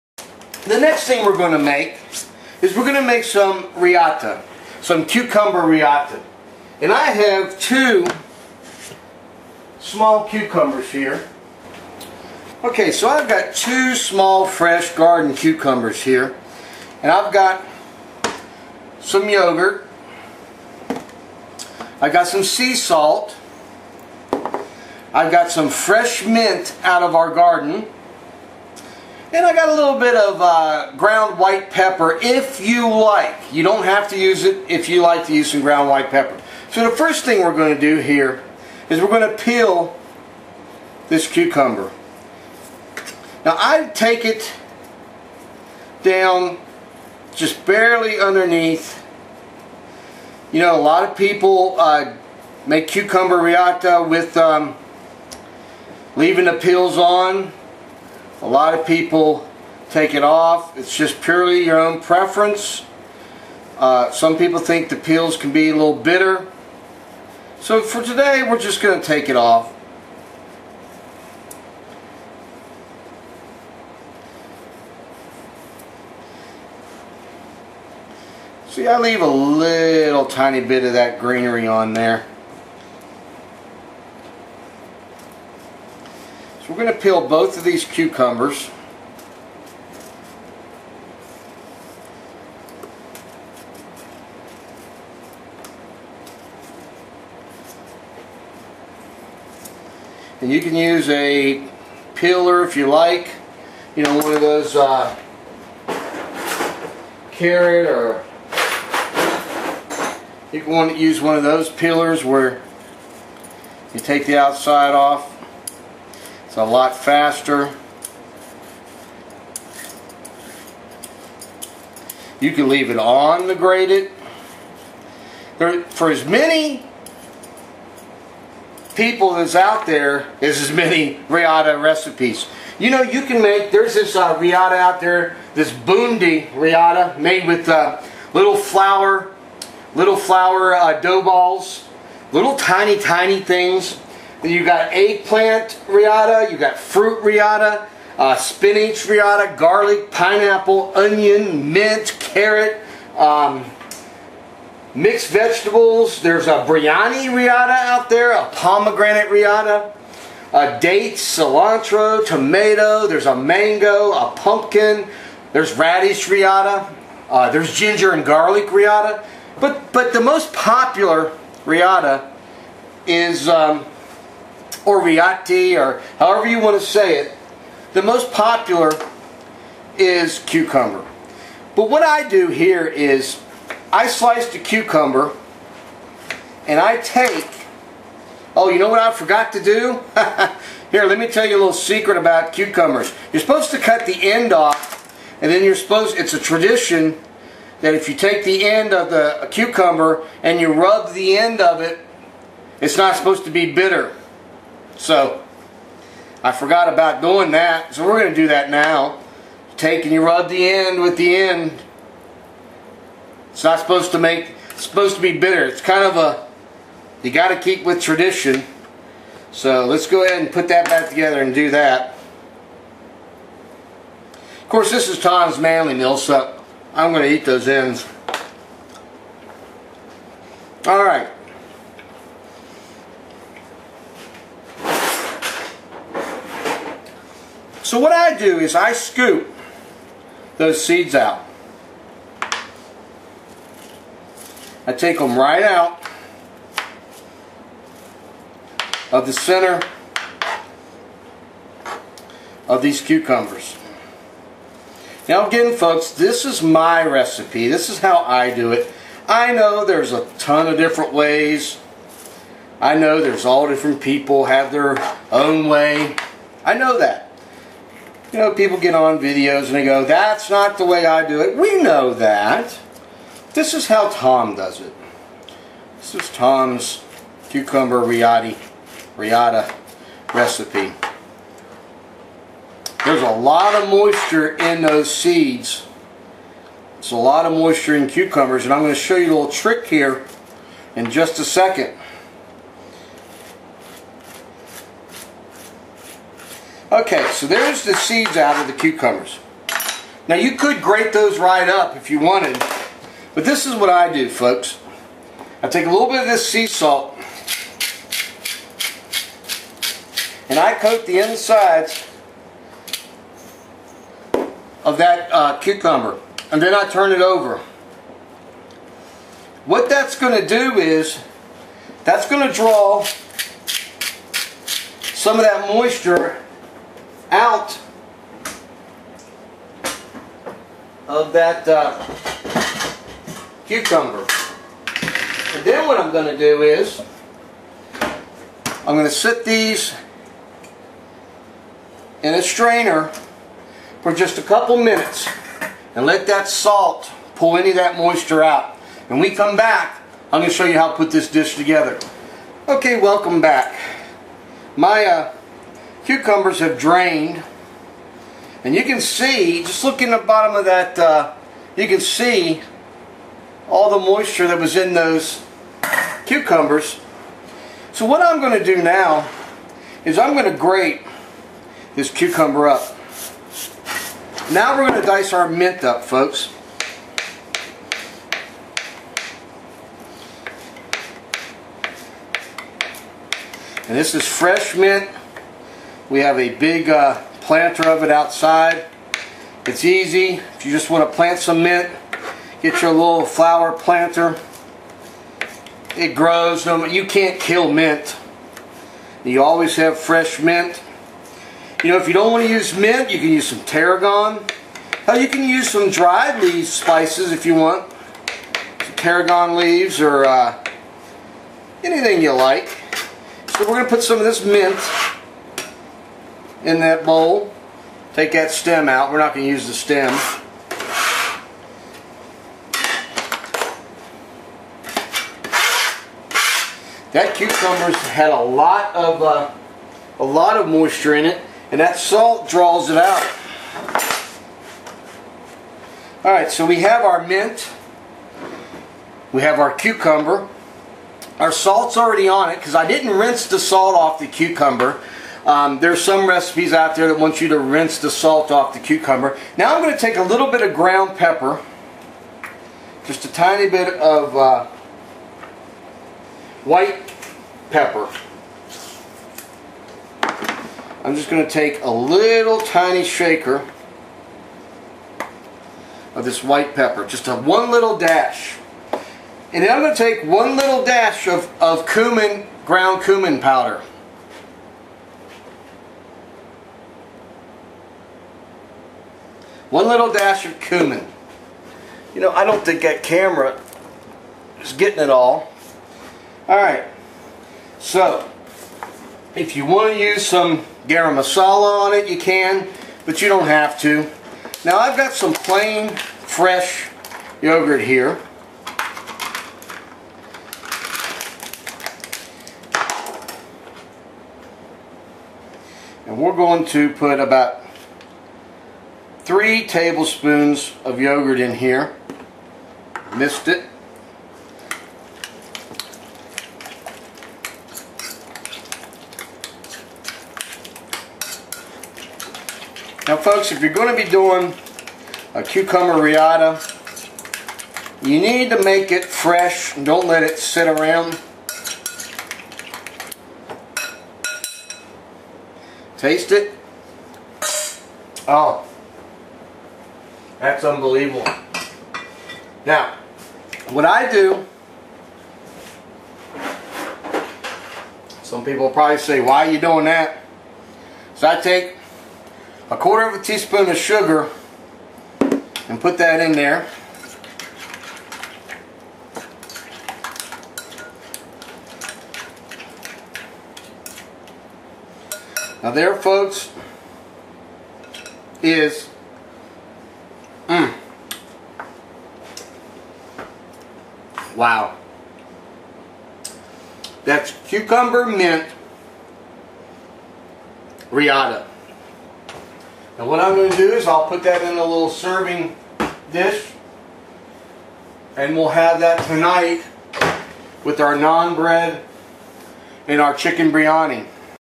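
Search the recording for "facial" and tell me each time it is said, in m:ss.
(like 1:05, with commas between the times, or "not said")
not said.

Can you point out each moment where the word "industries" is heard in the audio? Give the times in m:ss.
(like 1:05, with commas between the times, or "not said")
not said.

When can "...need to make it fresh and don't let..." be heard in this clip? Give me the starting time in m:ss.
8:48.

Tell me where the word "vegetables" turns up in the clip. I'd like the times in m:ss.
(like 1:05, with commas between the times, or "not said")
2:35.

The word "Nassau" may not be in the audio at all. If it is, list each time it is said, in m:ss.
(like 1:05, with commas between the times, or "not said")
not said.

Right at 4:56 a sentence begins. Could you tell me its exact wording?
Okay, so there's the seeds out of the cucumbers.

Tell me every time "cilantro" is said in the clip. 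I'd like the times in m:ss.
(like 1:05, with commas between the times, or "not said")
2:41.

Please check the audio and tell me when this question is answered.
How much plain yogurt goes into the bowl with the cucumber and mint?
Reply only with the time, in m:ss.
8:29.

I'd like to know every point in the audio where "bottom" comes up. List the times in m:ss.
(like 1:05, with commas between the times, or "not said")
6:00.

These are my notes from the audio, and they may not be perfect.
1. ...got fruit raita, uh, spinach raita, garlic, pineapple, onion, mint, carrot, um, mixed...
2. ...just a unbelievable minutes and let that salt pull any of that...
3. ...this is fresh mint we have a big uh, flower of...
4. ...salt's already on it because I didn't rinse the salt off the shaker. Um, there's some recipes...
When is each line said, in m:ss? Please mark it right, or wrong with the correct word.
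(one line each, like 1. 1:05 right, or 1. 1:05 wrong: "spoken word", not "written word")
1. 2:26 right
2. 5:44 wrong: "couple", not "unbelievable"
3. 6:23 wrong: "planter", not "flower"
4. 7:21 wrong: "cucumber", not "shaker".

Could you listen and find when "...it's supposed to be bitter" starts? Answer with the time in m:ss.
3:34.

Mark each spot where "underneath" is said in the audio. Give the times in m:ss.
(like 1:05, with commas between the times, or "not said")
0:48.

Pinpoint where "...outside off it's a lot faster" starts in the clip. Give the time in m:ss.
1:54.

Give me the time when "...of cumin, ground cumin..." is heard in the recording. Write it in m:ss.
7:51.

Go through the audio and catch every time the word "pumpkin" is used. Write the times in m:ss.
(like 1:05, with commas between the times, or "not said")
2:44.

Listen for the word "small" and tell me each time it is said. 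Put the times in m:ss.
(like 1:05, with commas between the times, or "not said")
0:09, 0:13.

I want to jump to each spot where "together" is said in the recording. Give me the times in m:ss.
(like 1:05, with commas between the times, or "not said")
3:41, 5:51.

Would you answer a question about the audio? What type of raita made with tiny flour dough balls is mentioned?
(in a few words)
bundi raita.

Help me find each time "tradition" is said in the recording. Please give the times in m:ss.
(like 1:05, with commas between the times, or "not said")
3:16, 3:37.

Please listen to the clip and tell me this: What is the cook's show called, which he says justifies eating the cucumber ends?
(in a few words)
Tom's Manly Meal.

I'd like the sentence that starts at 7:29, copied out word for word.
Now I'm going to take a little bit of ground pepper, just a tiny bit of uh, white pepper.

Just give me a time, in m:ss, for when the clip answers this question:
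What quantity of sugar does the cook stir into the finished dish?
9:12.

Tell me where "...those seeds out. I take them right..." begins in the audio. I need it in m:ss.
4:00.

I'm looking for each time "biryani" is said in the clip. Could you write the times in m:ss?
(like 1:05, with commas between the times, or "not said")
2:36, 9:53.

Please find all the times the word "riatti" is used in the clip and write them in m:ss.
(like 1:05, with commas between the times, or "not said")
2:55.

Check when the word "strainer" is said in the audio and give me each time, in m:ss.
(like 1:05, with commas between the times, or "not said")
5:42.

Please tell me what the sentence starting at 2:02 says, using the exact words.
You can leave it on the grated.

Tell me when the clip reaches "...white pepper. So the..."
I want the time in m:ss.
0:35.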